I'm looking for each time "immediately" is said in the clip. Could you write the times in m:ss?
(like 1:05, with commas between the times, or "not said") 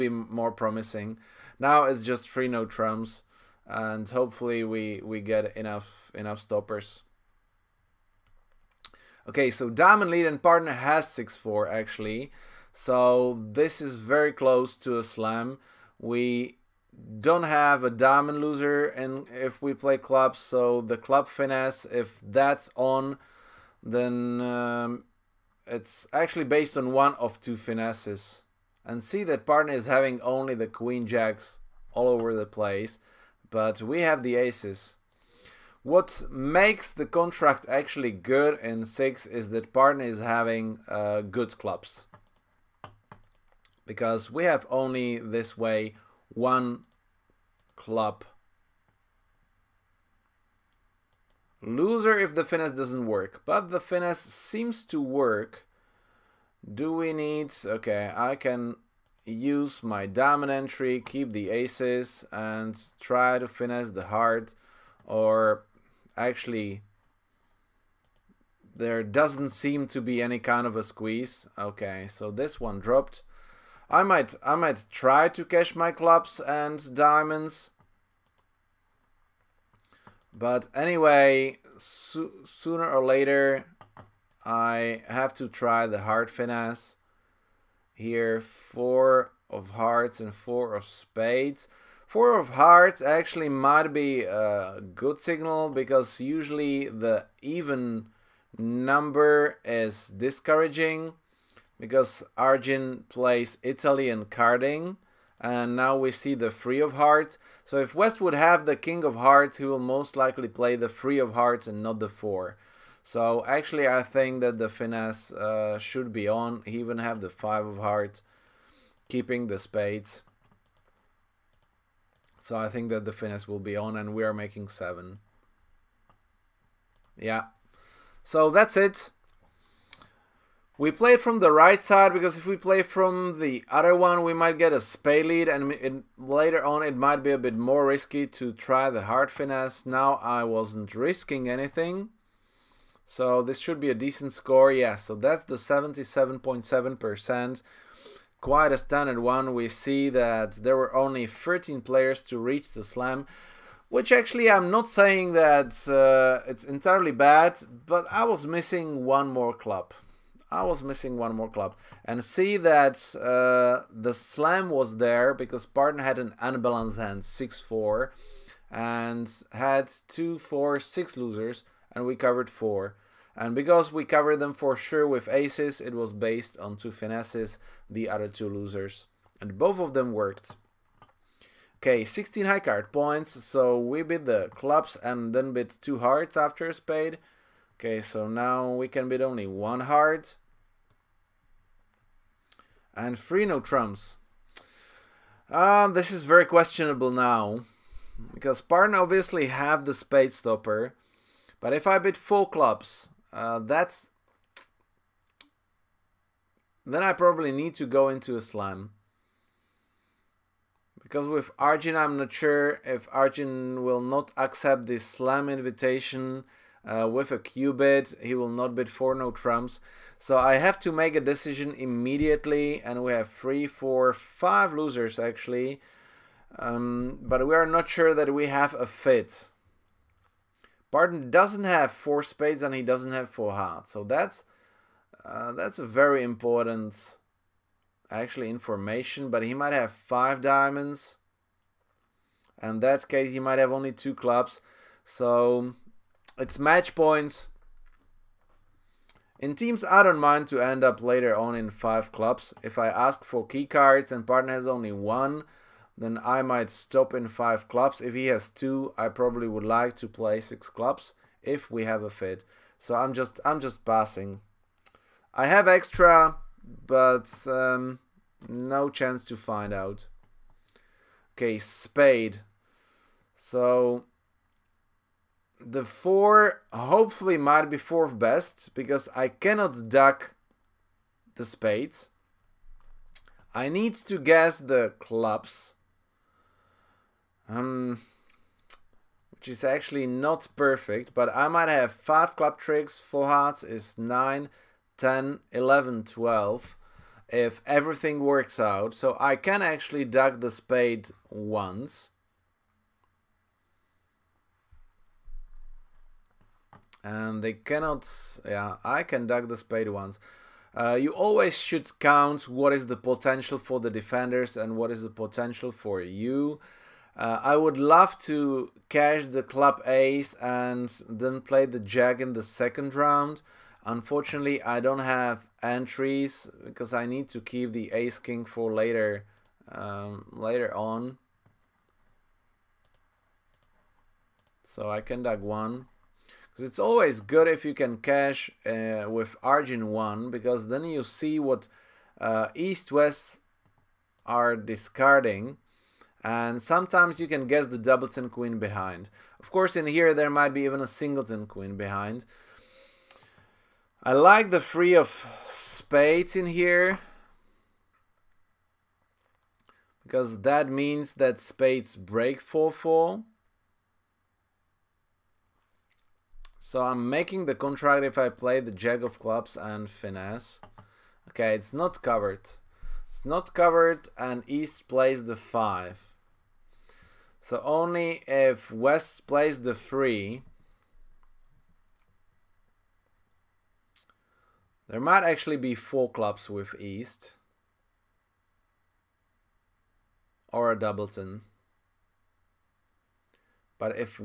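3:41.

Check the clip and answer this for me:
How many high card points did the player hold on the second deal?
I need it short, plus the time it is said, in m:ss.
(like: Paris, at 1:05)
16, at 3:02.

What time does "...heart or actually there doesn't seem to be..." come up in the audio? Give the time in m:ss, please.
1:04.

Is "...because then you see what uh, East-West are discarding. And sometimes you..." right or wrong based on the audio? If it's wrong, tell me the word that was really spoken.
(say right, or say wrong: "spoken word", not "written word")
right.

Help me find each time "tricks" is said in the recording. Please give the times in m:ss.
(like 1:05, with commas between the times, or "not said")
4:52.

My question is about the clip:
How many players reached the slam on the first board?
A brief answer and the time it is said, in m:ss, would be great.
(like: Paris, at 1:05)
13, at 2:31.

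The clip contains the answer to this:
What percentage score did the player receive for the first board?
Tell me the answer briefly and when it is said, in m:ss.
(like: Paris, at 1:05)
77.7%, at 2:25.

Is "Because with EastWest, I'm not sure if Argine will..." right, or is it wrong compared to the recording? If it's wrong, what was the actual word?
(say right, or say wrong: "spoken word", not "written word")
wrong: "Argine", not "EastWest".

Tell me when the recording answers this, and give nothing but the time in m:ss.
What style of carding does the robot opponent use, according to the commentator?
1:43.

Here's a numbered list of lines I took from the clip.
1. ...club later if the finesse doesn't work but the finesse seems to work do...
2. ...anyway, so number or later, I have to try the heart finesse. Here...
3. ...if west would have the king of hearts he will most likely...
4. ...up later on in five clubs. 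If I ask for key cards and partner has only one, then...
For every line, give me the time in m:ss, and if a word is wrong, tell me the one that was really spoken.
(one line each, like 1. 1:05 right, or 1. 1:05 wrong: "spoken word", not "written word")
1. 0:47 wrong: "loser", not "later"
2. 1:20 wrong: "sooner", not "number"
3. 1:47 right
4. 4:10 right.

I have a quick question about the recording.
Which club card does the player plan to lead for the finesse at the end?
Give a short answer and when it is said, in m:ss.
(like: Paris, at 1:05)
Jack of Clubs, at 6:08.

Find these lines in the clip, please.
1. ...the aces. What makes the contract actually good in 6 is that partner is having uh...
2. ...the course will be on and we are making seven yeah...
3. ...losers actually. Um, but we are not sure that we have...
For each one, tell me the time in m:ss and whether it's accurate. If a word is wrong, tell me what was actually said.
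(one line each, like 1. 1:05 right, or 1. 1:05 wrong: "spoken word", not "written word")
1. 0:34 right
2. 2:03 wrong: "finesse", not "course"
3. 3:44 right.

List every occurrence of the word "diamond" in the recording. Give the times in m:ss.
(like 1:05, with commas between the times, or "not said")
0:09, 0:17, 1:16, 4:00.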